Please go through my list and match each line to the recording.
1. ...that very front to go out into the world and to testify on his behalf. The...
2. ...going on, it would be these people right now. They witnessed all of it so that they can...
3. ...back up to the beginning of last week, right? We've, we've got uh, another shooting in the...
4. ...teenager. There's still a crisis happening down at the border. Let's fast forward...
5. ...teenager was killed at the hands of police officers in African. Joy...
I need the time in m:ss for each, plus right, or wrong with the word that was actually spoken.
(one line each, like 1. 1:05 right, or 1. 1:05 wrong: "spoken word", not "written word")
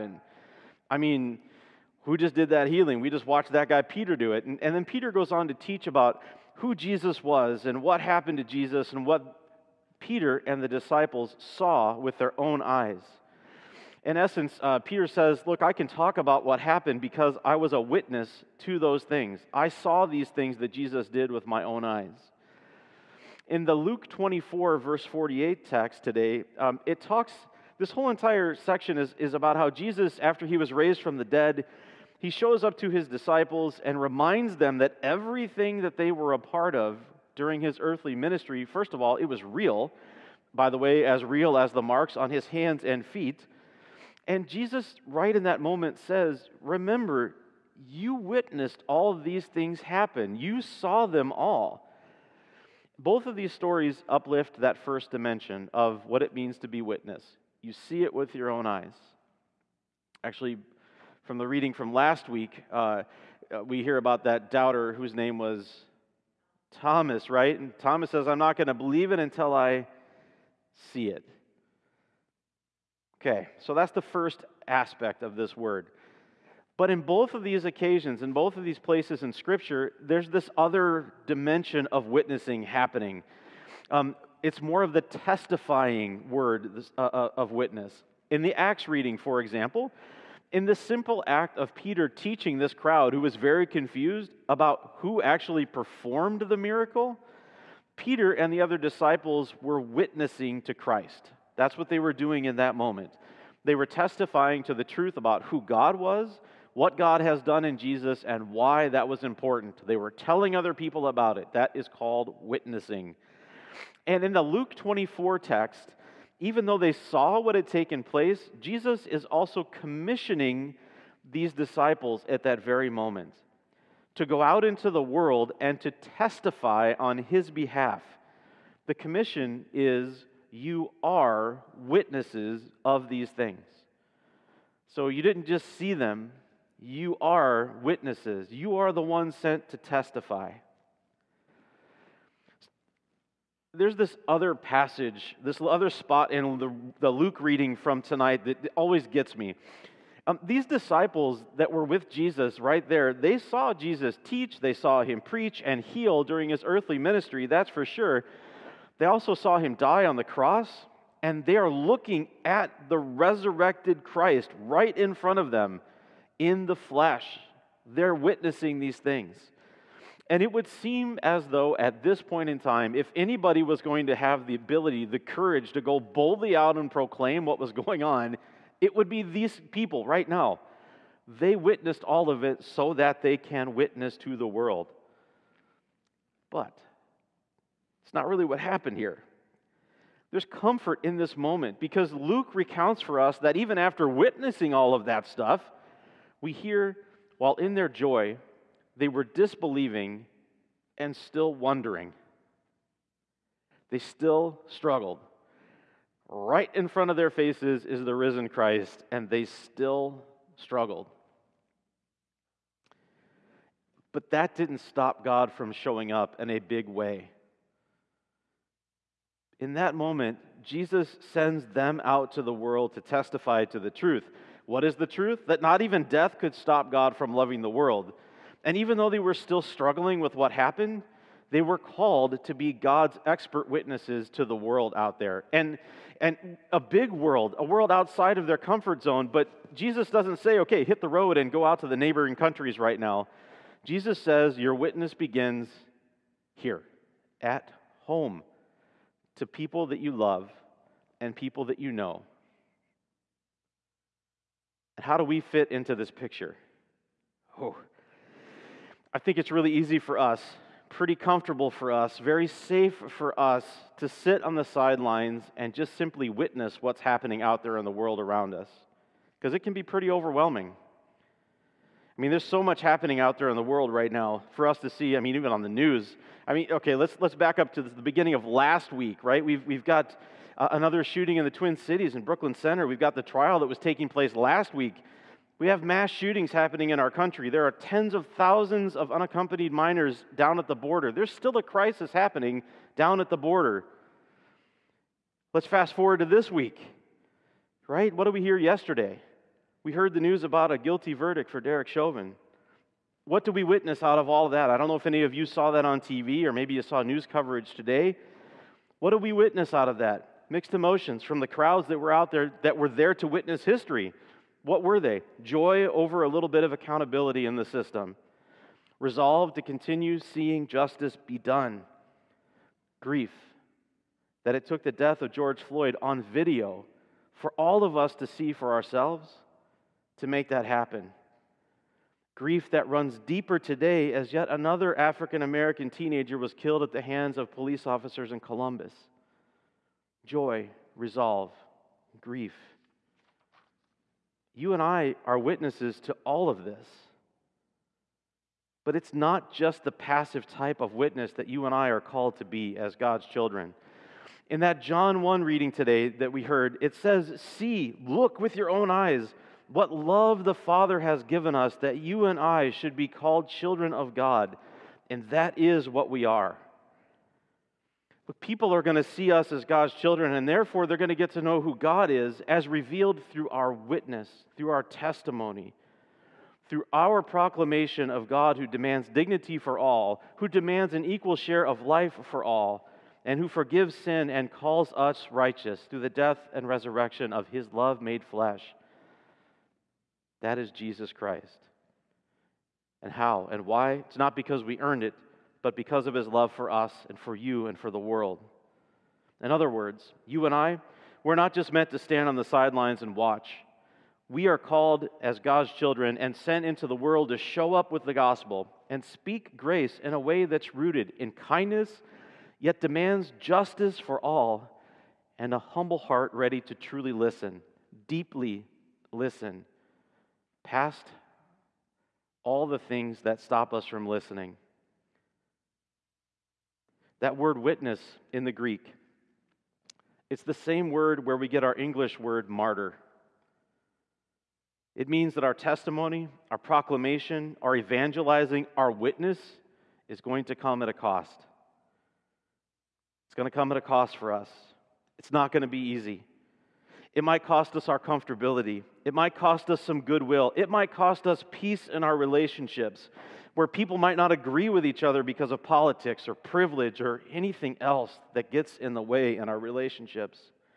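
1. 2:02 wrong: "moment", not "front"
2. 2:57 right
3. 4:37 right
4. 4:50 wrong: "border", not "teenager"
5. 5:35 wrong: "Columbus", not "African".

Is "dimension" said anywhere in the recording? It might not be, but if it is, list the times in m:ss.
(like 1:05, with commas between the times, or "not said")
0:55, 1:21.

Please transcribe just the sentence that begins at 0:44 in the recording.
And Jesus, right in that moment, says, Remember, you witnessed all these things happen, you saw them all.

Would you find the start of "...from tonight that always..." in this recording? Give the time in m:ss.
2:27.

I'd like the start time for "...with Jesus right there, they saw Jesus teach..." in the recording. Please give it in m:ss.
2:31.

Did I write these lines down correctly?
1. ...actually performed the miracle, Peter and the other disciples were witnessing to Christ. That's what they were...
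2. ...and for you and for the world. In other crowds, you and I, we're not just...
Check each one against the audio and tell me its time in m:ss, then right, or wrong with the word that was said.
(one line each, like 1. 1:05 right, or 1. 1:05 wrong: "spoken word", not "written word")
1. 1:35 right
2. 6:37 wrong: "words", not "crowds".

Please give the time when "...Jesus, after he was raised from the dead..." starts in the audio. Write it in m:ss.
0:29.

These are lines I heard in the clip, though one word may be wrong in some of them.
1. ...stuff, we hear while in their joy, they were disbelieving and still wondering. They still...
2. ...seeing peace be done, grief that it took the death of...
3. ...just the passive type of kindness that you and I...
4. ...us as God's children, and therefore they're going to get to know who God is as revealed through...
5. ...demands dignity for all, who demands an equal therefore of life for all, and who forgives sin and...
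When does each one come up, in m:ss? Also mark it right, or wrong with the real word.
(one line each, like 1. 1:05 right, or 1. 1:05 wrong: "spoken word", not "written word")
1. 3:15 right
2. 5:20 wrong: "justice", not "peace"
3. 5:49 wrong: "witness", not "kindness"
4. 6:09 right
5. 6:18 wrong: "share", not "therefore".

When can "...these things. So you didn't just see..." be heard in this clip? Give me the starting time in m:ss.
2:13.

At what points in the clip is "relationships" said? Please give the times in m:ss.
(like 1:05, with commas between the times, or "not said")
7:32, 7:39.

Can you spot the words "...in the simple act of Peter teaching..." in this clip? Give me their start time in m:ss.
1:30.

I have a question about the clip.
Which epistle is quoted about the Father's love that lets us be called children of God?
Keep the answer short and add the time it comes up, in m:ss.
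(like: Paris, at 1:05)
John 1, at 5:54.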